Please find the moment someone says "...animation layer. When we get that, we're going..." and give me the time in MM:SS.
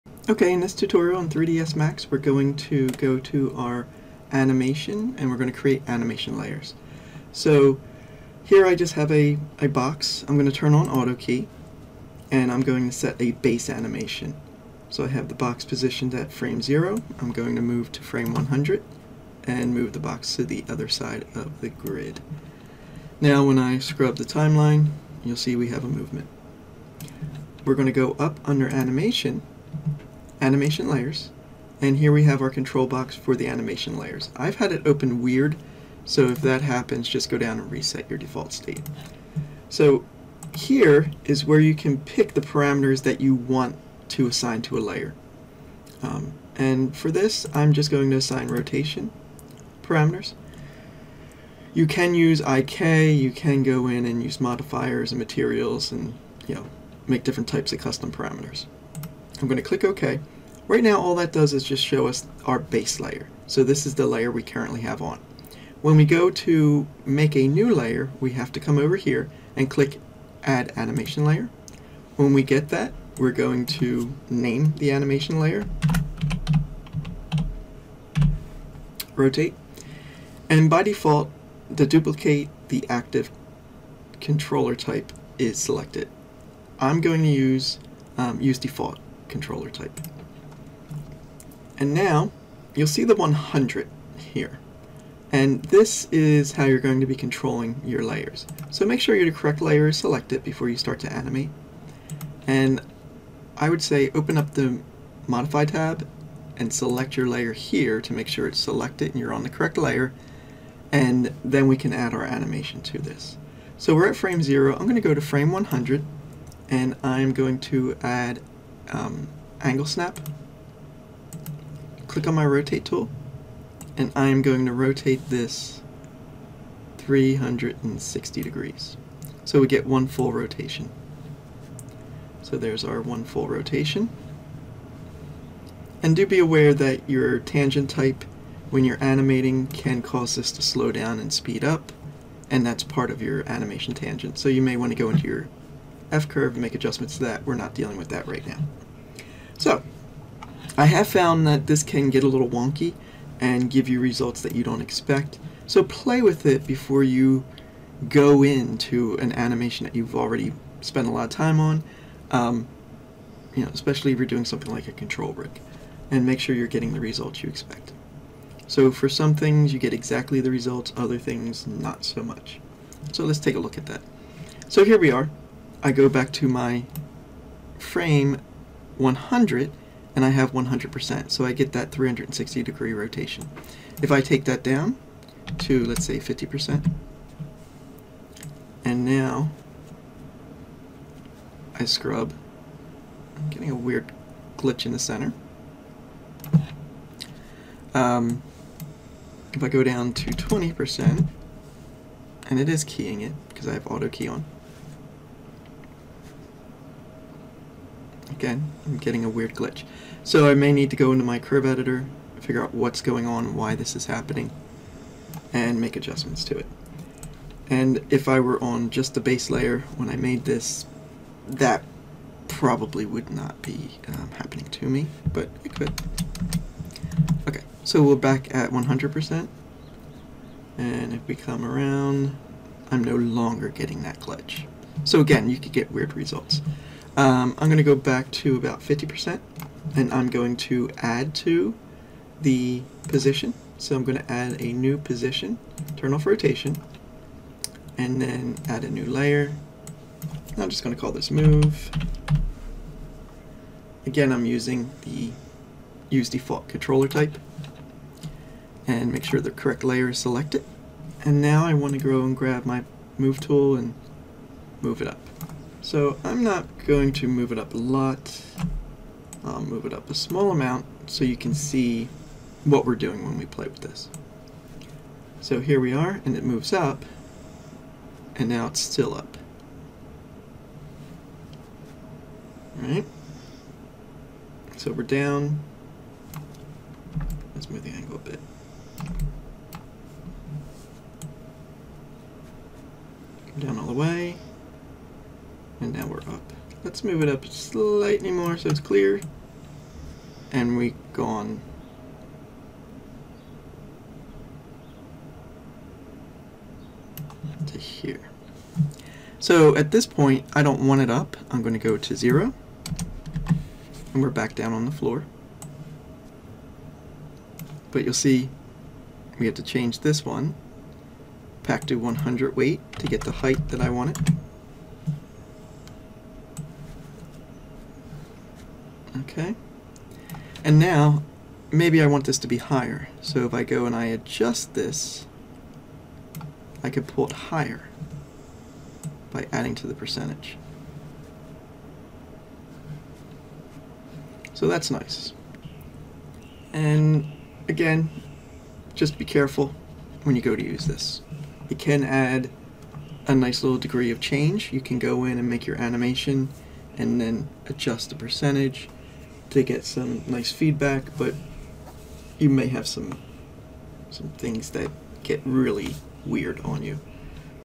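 01:10.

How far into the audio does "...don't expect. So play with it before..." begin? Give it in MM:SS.
02:34.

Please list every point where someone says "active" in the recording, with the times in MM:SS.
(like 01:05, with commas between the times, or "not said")
01:22.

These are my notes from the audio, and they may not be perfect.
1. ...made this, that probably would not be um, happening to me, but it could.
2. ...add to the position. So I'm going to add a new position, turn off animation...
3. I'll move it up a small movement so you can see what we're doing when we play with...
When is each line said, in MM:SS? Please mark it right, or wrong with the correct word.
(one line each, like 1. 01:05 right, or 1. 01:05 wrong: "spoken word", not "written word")
1. 03:40 right
2. 04:00 wrong: "rotation", not "animation"
3. 04:29 wrong: "amount", not "movement".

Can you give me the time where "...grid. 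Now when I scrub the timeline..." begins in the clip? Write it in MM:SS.
00:21.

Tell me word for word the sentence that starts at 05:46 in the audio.
And again, just be careful when you go to use this.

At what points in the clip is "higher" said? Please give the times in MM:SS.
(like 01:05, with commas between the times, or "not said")
05:32, 05:37.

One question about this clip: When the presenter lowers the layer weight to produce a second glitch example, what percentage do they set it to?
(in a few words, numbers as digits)
20%.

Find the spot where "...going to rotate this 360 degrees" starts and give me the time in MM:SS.
02:04.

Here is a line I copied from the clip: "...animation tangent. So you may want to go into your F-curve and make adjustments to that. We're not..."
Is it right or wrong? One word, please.
right.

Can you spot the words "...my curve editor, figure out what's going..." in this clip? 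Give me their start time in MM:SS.
03:31.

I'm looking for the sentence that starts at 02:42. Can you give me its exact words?
Um, you know, especially if you're doing something like a control rig.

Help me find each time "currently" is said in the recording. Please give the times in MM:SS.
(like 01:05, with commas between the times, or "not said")
01:04.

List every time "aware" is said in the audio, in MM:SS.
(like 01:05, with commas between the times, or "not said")
02:16.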